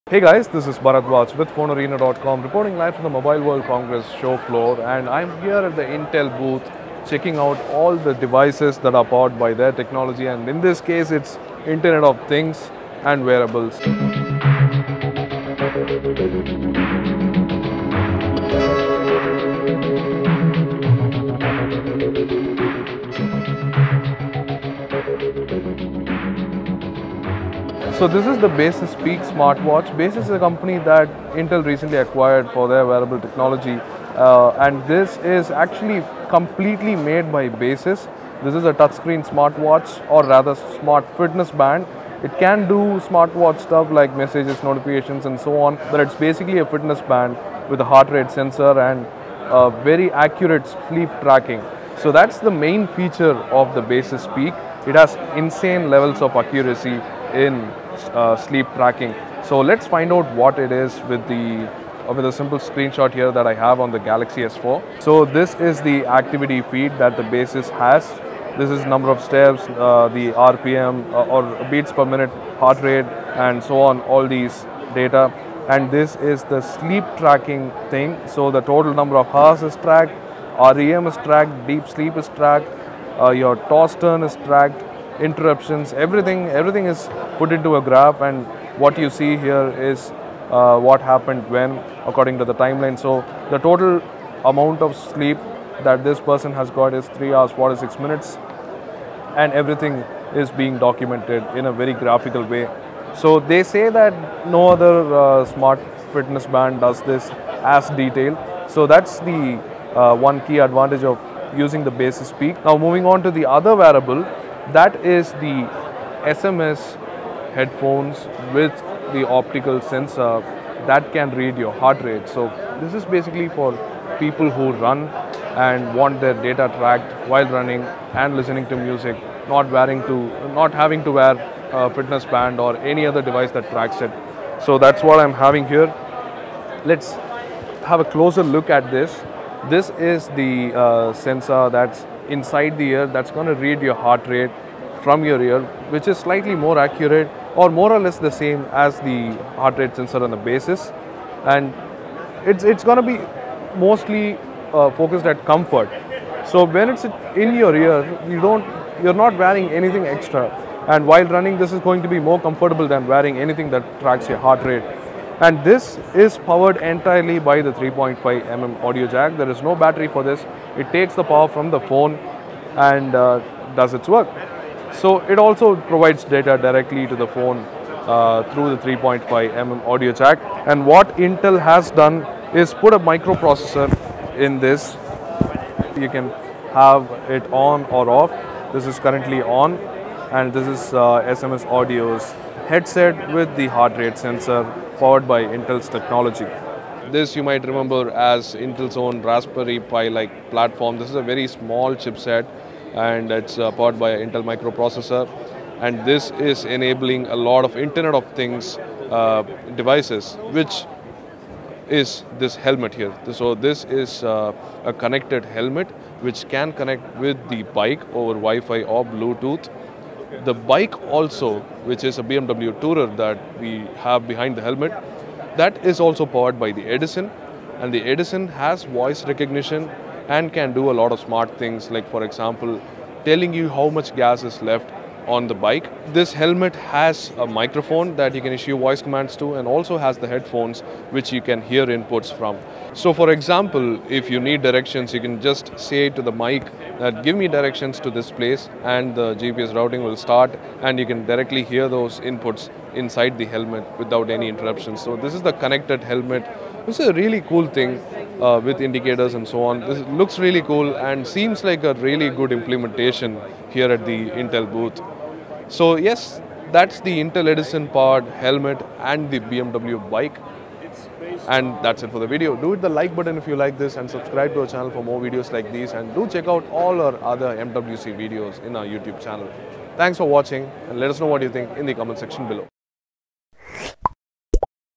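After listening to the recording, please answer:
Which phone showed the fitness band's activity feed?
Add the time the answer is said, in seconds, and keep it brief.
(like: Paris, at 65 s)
Galaxy S4, at 63 s.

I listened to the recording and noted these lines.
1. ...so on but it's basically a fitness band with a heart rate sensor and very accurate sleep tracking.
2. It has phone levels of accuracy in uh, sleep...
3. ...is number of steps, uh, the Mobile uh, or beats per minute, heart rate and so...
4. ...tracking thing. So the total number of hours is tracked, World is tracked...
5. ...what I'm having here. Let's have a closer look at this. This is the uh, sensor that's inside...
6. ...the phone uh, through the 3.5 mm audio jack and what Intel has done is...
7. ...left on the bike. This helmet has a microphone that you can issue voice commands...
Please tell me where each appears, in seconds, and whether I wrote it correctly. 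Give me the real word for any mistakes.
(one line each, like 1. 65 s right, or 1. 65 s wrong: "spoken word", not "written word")
1. 45 s right
2. 54 s wrong: "insane", not "phone"
3. 68 s wrong: "RPM", not "Mobile"
4. 77 s wrong: "REM", not "World"
5. 135 s right
6. 177 s right
7. 234 s right.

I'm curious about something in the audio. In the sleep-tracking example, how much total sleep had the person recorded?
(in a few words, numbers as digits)
3 hours 46 minutes.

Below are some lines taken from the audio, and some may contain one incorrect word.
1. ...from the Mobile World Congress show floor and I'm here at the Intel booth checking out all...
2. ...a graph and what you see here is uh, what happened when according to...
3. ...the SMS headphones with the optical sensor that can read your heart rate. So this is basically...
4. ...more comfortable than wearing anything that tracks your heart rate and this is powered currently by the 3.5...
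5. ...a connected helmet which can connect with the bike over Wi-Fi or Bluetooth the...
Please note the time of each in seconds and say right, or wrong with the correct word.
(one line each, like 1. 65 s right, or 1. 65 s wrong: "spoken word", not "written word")
1. 2 s right
2. 87 s right
3. 115 s right
4. 162 s wrong: "entirely", not "currently"
5. 214 s right.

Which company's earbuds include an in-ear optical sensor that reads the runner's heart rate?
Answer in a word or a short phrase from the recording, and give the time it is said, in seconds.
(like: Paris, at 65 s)
SMS Audio, at 191 s.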